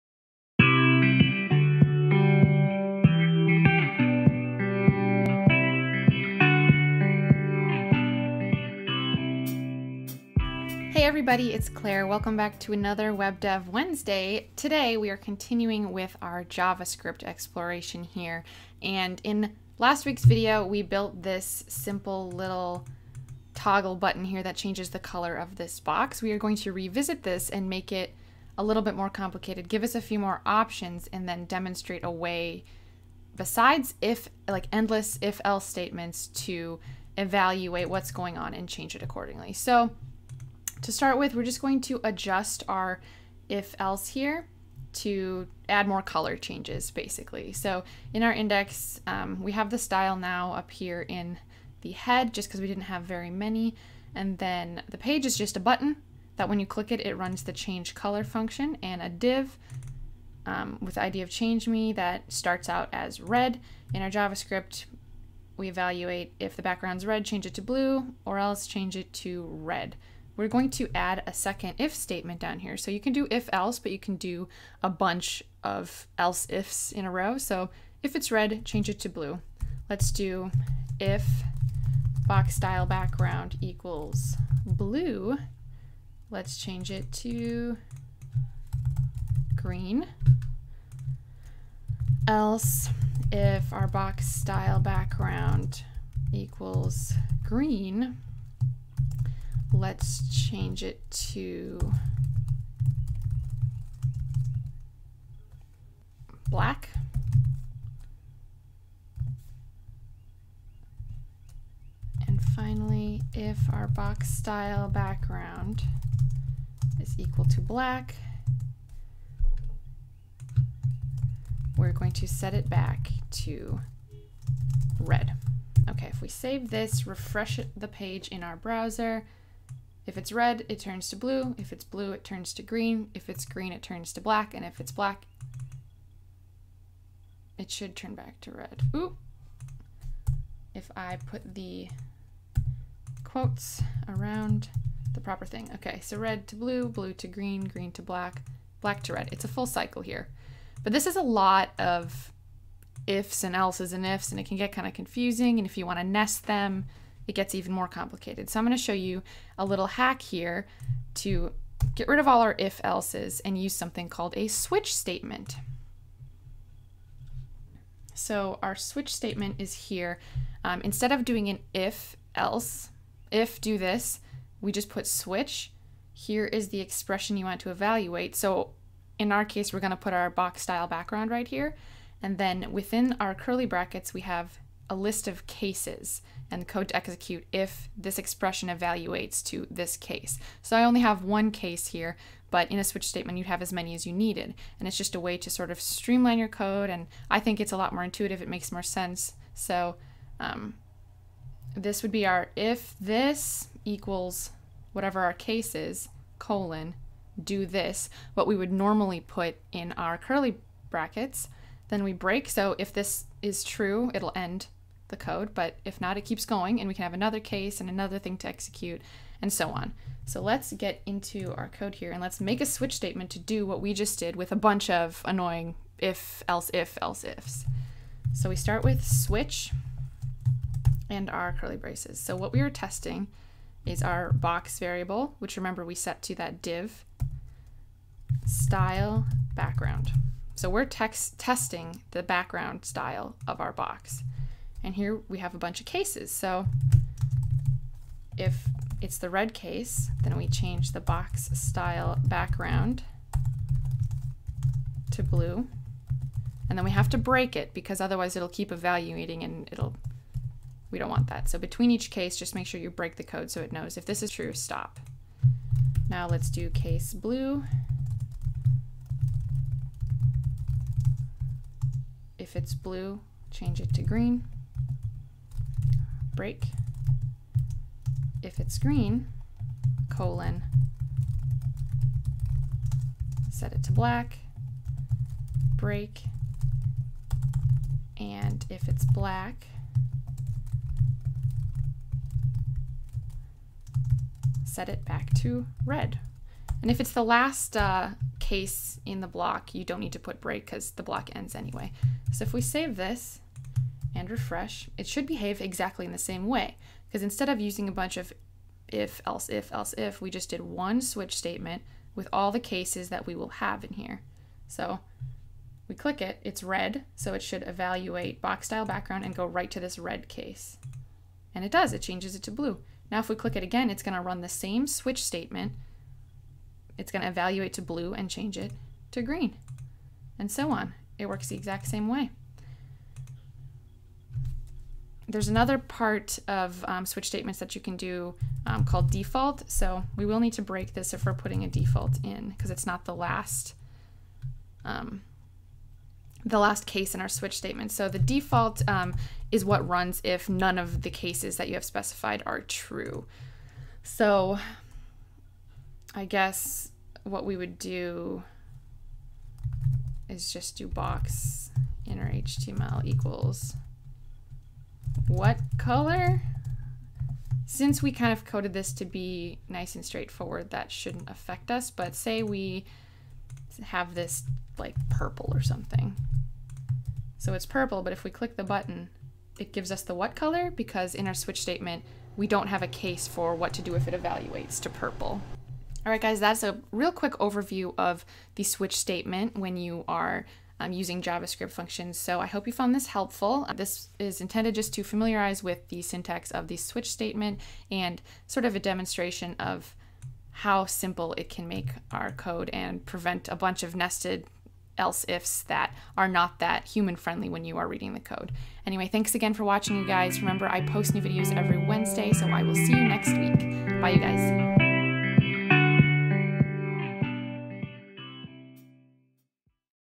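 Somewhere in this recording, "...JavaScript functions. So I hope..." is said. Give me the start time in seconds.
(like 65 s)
391 s.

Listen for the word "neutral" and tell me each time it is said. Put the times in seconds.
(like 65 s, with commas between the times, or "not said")
not said.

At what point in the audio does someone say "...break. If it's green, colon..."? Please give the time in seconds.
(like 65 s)
276 s.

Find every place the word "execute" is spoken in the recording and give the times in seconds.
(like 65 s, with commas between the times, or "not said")
186 s, 218 s.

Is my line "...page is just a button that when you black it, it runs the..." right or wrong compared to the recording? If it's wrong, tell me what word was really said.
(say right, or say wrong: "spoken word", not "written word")
wrong: "click", not "black".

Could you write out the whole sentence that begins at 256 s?
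And then we have to break it because otherwise it'll keep evaluating and it'll, we don't want that.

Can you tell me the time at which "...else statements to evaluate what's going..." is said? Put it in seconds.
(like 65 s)
35 s.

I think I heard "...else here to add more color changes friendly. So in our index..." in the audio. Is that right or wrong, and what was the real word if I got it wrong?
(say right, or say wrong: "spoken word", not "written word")
wrong: "basically", not "friendly".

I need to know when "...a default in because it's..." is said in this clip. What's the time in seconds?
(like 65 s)
341 s.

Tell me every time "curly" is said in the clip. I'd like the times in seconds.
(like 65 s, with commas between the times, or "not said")
183 s, 210 s, 231 s.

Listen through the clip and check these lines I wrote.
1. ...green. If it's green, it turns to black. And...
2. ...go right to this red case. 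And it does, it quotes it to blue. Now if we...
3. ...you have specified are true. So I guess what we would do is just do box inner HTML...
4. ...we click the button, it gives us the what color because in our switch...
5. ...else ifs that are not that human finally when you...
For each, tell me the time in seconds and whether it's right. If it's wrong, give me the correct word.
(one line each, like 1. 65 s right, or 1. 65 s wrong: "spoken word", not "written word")
1. 132 s right
2. 319 s wrong: "changes", not "quotes"
3. 351 s right
4. 378 s right
5. 404 s wrong: "friendly", not "finally".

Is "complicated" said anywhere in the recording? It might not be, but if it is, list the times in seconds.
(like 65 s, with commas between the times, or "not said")
29 s, 157 s.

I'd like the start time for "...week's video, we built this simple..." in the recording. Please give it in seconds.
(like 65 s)
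20 s.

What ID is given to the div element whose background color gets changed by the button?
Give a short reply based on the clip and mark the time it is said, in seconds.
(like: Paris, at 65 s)
change me, at 61 s.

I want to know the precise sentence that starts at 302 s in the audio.
So if we save this, and refresh, it should behave exactly in the same way.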